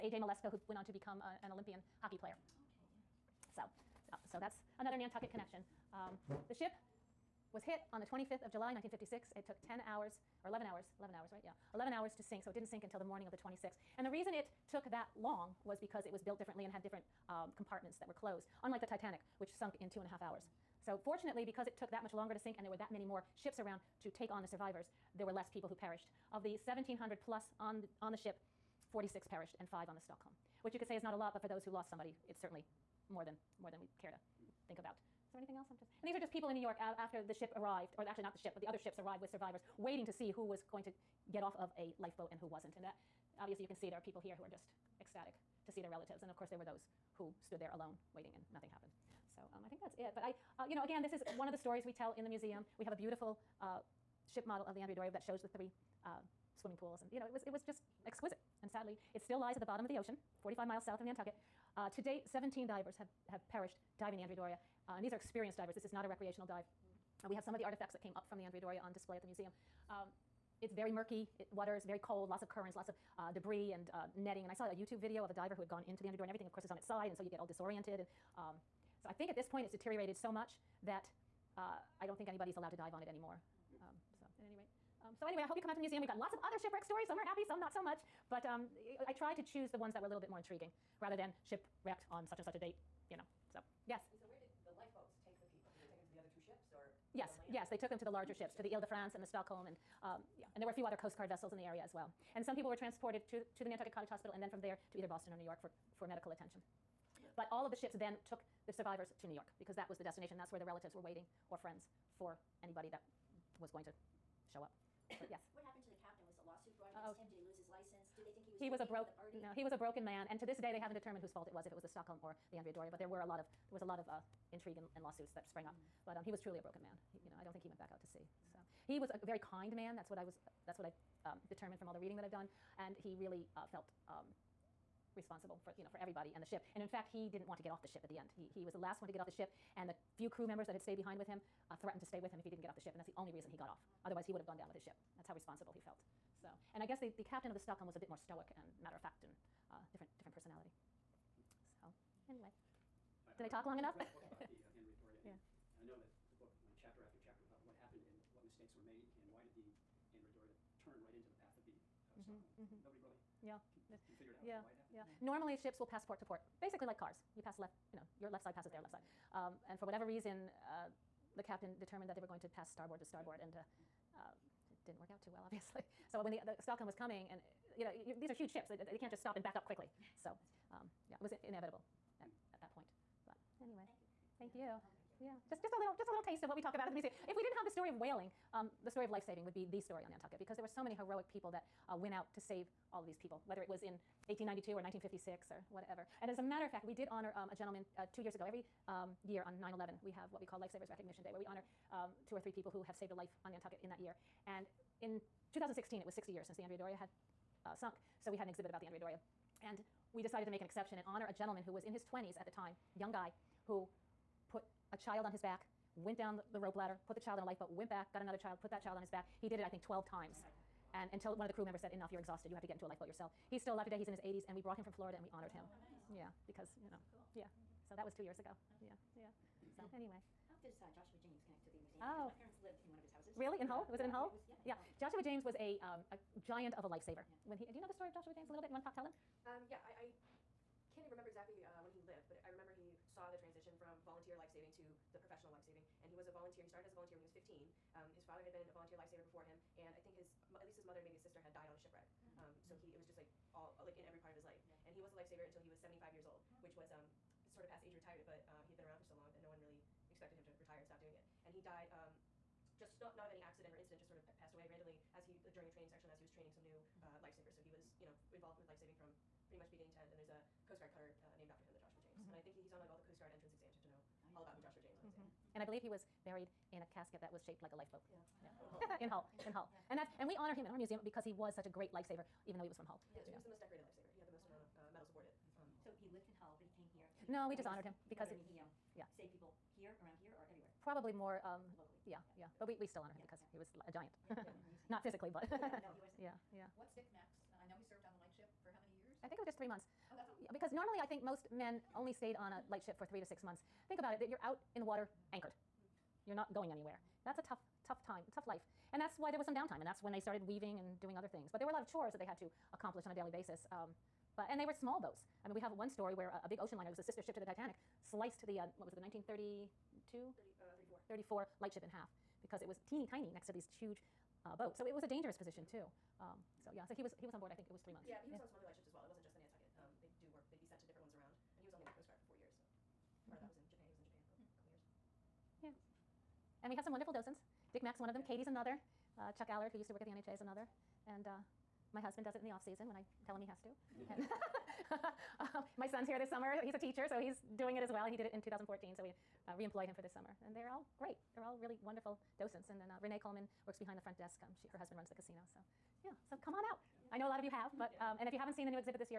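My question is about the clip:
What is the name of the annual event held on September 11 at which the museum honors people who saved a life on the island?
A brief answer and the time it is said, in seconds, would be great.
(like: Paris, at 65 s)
Lifesavers Recognition Day, at 200 s.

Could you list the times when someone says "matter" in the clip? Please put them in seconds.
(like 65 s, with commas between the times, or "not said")
148 s, 196 s.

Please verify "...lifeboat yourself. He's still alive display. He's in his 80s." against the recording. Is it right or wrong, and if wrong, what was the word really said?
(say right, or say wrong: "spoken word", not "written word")
wrong: "today", not "display".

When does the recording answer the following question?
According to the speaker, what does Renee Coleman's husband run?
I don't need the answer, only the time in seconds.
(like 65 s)
355 s.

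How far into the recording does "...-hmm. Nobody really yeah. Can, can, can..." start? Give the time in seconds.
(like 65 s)
162 s.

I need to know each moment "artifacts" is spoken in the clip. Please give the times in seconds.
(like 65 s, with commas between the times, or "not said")
67 s.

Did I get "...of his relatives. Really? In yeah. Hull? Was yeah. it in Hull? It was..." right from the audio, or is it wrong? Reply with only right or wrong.
wrong.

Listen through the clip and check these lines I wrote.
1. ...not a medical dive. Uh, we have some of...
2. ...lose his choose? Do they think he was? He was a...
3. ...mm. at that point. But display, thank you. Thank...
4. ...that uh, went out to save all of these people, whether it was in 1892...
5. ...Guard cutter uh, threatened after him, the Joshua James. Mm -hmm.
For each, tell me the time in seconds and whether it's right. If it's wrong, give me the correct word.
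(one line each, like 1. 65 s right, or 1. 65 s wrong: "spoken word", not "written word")
1. 65 s wrong: "recreational", not "medical"
2. 117 s wrong: "license", not "choose"
3. 182 s wrong: "anyway", not "display"
4. 191 s right
5. 270 s wrong: "named", not "threatened".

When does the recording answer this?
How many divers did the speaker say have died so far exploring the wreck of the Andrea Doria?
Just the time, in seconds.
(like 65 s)
62 s.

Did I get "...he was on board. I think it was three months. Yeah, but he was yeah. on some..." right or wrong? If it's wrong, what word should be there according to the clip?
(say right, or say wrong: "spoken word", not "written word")
right.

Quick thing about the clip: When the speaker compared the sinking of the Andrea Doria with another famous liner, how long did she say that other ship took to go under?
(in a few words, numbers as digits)
2.5 hours.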